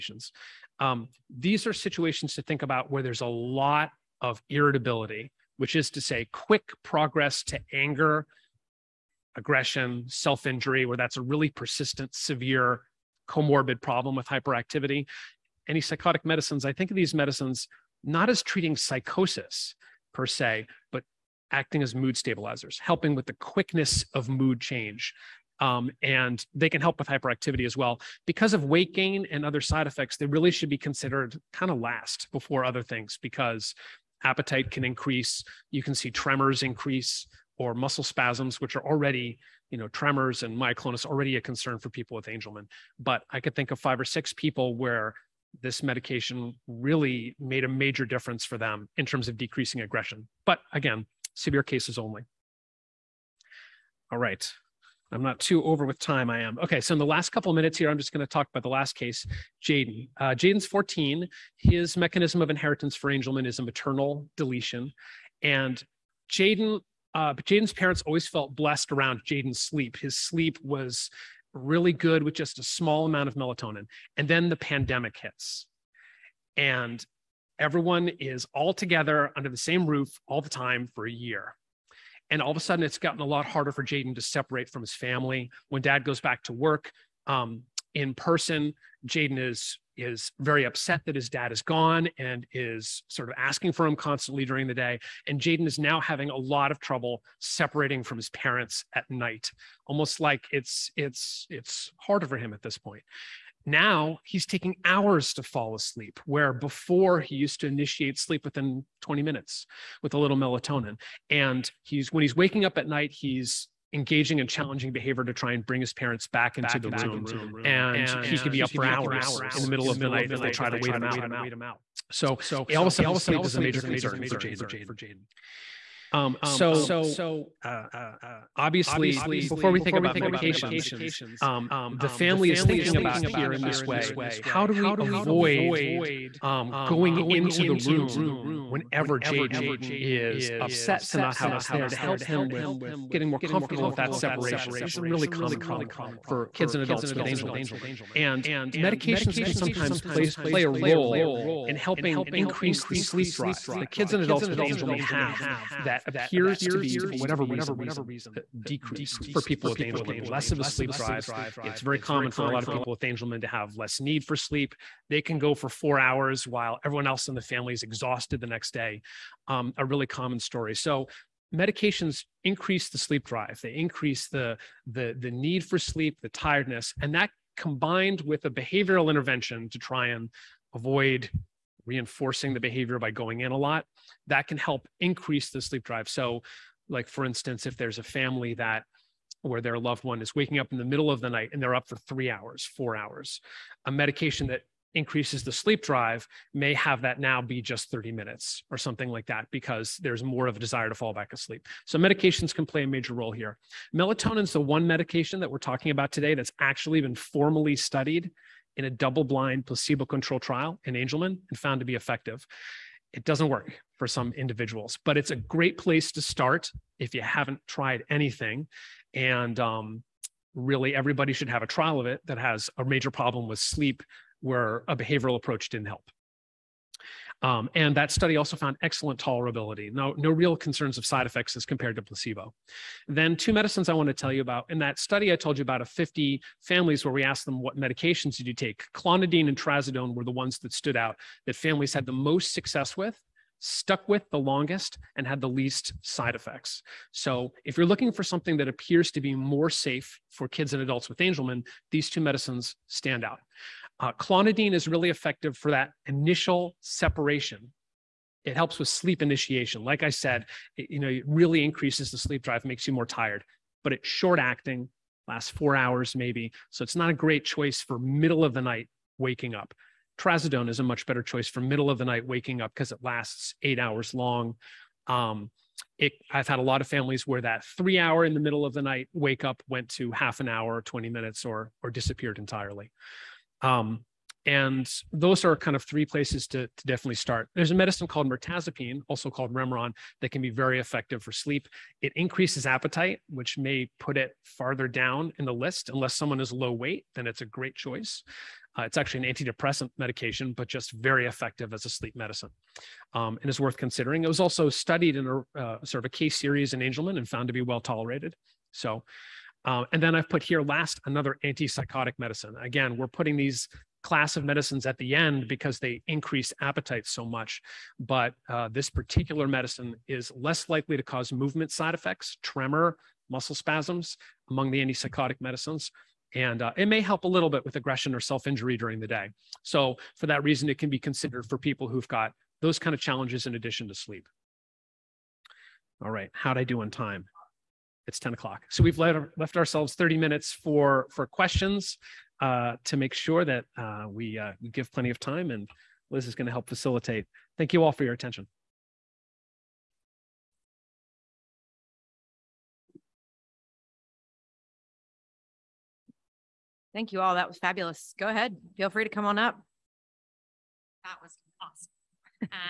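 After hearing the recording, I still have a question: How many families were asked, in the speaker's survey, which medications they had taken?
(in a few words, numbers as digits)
50.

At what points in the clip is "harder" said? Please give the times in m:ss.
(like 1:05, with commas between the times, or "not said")
1:23, 1:41.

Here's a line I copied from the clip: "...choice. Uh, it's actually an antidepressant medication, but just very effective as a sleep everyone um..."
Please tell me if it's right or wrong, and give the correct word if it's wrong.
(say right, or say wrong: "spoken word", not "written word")
wrong: "medicine", not "everyone".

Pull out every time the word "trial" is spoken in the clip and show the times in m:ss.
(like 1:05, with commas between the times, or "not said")
3:30, 3:41.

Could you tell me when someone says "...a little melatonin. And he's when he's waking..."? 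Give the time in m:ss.
1:50.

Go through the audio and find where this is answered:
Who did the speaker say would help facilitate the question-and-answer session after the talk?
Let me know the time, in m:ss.
5:46.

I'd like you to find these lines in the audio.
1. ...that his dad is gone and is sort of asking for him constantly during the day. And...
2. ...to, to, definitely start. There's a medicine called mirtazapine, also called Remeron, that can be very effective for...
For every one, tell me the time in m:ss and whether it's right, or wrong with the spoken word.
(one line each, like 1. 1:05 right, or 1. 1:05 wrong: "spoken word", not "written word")
1. 1:31 right
2. 4:46 right.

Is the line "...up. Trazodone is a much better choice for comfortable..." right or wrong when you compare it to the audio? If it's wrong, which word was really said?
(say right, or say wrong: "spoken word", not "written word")
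wrong: "middle", not "comfortable".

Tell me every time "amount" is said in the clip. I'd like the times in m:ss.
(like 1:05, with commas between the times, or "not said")
1:13.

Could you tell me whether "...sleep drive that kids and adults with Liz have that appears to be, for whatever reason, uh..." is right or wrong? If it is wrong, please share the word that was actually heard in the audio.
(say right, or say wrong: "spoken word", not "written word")
wrong: "Angelman", not "Liz".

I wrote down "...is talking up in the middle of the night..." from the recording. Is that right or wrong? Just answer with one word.
wrong.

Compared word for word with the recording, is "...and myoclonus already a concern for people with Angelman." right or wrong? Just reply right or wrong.
right.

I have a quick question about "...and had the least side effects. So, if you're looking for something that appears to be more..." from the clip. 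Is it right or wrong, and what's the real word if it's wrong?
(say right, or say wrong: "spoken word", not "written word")
right.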